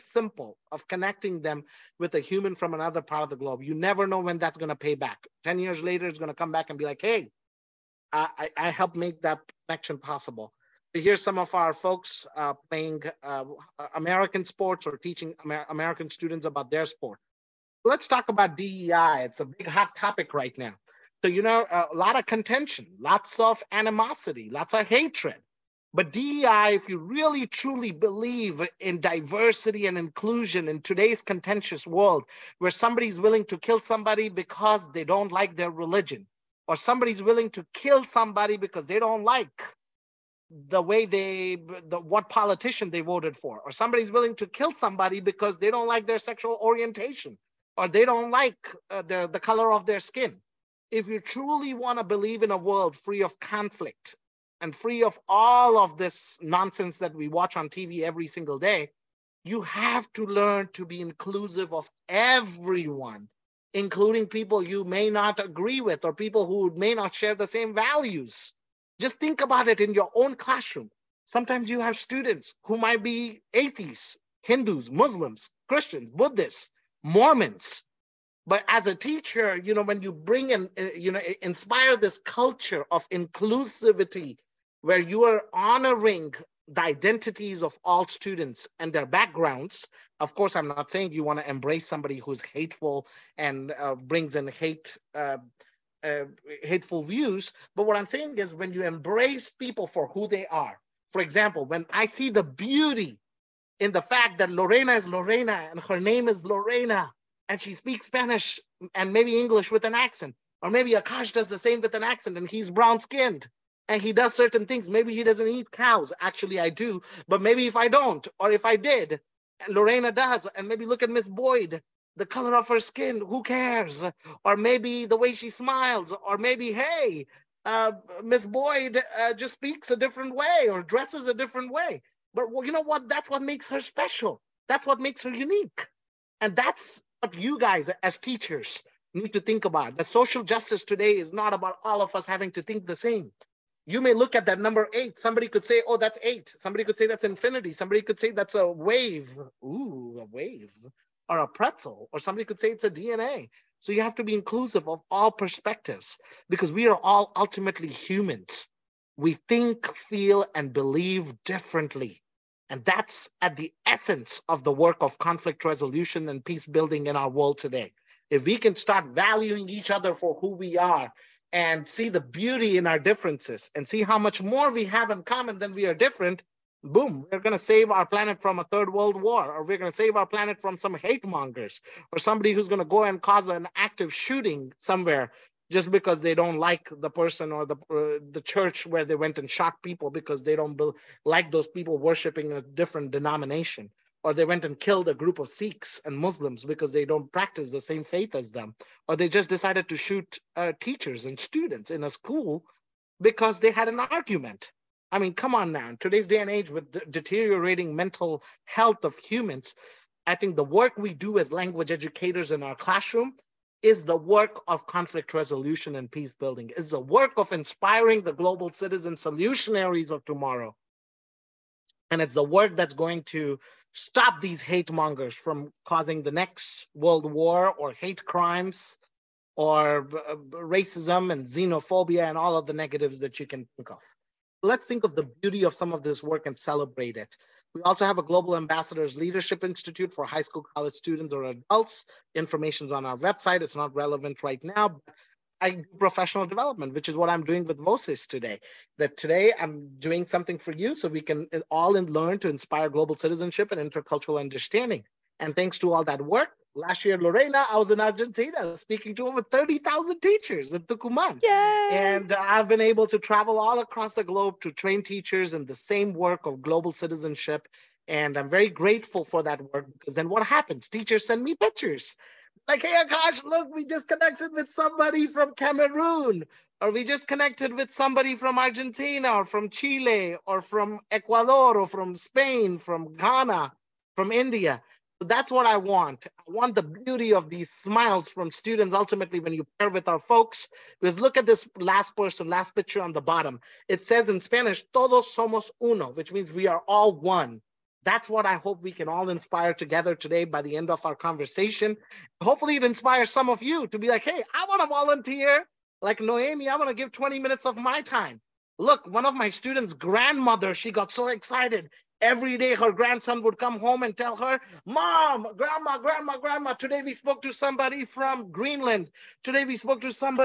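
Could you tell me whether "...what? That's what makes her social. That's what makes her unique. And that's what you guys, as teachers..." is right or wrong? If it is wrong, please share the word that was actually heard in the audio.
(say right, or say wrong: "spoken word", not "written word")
wrong: "special", not "social".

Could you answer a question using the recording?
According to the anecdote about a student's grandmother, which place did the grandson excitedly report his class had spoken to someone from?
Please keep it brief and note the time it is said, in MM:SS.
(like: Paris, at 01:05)
Greenland, at 05:18.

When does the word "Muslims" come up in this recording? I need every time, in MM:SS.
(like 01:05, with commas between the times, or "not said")
01:14, 03:16.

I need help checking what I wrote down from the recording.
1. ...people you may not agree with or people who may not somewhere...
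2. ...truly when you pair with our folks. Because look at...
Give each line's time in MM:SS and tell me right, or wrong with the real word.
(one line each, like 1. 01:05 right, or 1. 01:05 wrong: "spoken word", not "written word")
1. 01:04 wrong: "share", not "somewhere"
2. 04:48 wrong: "ultimately", not "truly".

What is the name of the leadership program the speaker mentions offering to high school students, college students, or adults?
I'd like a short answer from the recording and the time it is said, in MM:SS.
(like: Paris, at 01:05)
Global Ambassadors Leadership Institute, at 03:58.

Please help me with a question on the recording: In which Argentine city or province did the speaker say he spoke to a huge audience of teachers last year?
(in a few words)
Tucumán.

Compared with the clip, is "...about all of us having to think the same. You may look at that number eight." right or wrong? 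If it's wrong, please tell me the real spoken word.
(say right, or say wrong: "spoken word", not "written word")
right.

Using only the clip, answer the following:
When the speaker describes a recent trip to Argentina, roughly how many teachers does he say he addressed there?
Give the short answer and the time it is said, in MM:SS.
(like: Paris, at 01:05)
30,000, at 04:19.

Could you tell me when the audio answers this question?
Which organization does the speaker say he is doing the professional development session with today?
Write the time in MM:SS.
04:07.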